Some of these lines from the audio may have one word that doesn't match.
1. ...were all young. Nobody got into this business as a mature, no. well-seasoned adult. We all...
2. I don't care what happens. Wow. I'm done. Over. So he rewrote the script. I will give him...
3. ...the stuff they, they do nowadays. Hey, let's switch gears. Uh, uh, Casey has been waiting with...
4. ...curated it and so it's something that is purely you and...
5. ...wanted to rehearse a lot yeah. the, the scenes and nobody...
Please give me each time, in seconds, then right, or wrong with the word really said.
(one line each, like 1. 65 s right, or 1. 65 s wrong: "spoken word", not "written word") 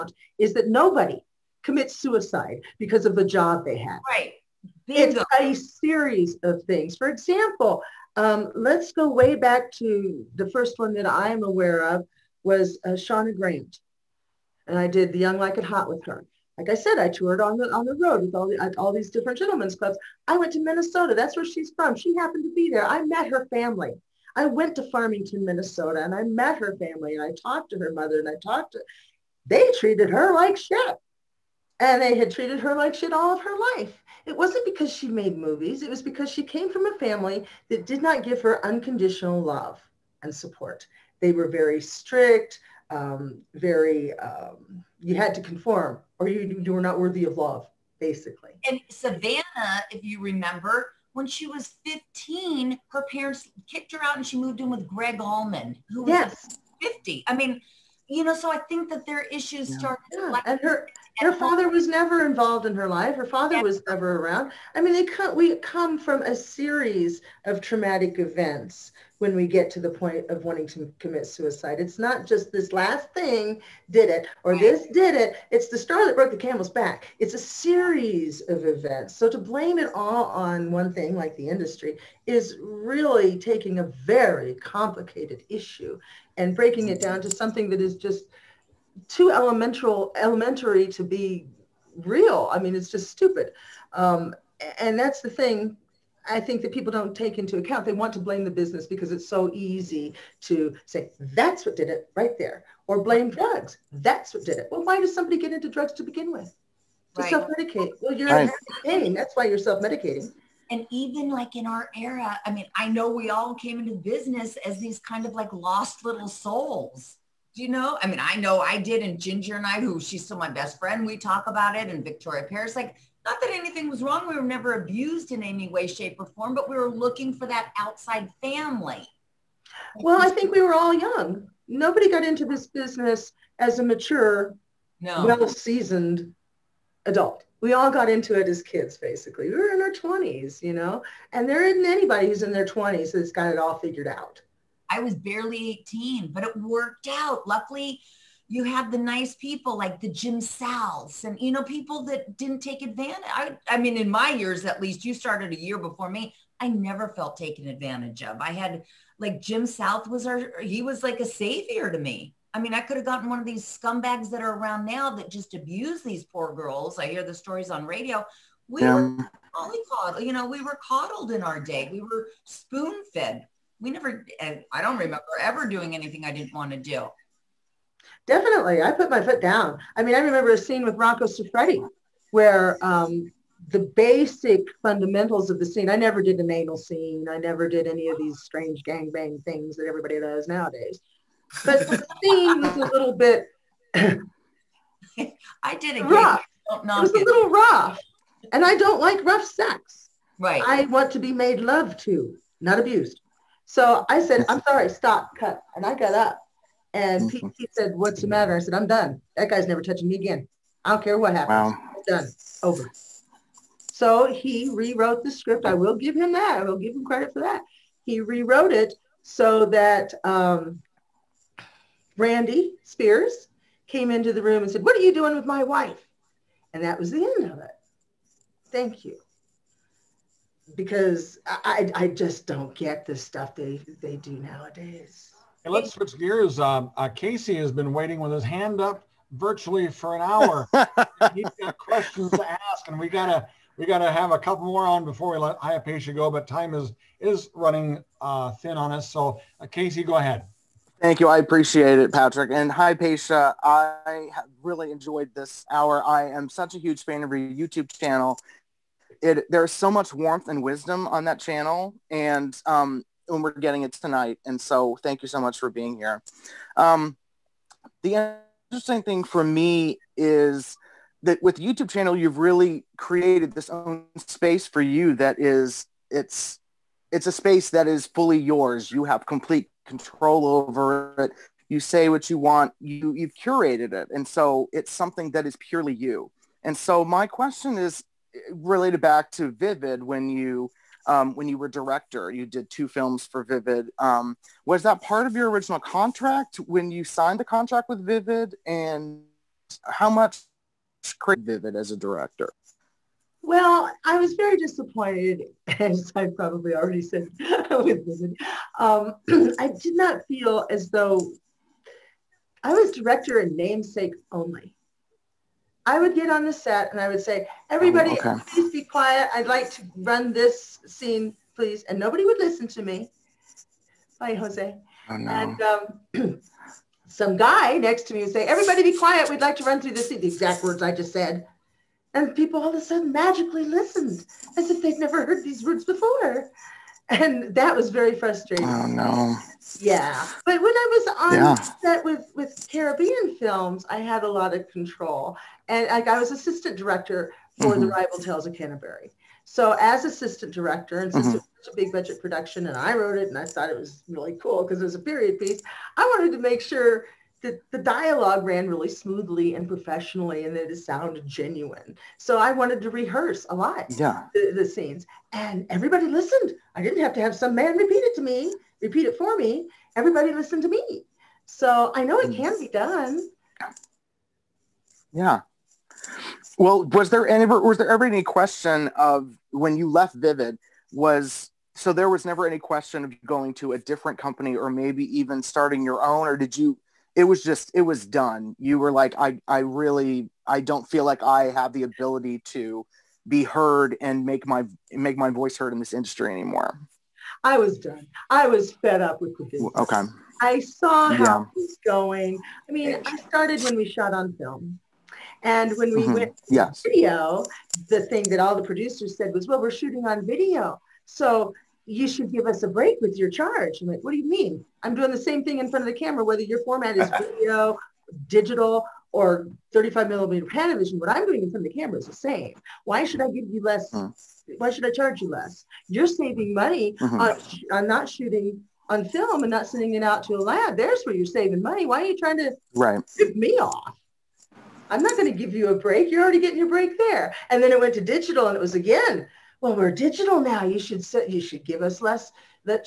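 1. 130 s right
2. 210 s right
3. 233 s right
4. 283 s right
5. 362 s wrong: "everybody", not "nobody".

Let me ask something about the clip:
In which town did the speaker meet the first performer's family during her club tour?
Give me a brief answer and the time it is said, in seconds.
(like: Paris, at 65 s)
Farmington, Minnesota, at 24 s.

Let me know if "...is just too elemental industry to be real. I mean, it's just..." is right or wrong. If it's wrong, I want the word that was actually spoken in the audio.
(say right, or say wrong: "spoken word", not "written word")
wrong: "elementary", not "industry".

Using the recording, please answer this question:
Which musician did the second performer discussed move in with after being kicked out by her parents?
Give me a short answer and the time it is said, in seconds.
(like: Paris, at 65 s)
Gregg Allman, at 54 s.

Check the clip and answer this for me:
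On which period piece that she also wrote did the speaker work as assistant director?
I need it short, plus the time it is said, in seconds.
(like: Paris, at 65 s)
The Ribald Tales of Canterbury, at 347 s.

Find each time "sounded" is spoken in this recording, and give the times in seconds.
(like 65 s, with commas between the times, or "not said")
360 s.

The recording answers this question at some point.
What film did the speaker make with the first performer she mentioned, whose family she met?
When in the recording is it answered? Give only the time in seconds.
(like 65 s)
15 s.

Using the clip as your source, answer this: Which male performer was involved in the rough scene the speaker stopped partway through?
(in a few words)
Rocco Siffredi.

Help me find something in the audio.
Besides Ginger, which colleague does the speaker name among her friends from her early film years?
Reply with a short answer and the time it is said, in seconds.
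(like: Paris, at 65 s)
Victoria Paris, at 122 s.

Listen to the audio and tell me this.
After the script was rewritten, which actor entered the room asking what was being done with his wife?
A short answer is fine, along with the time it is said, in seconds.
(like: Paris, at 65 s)
Randy Spears, at 222 s.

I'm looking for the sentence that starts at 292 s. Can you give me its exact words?
You did two films for Vivid.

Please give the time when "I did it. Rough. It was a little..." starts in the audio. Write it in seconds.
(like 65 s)
195 s.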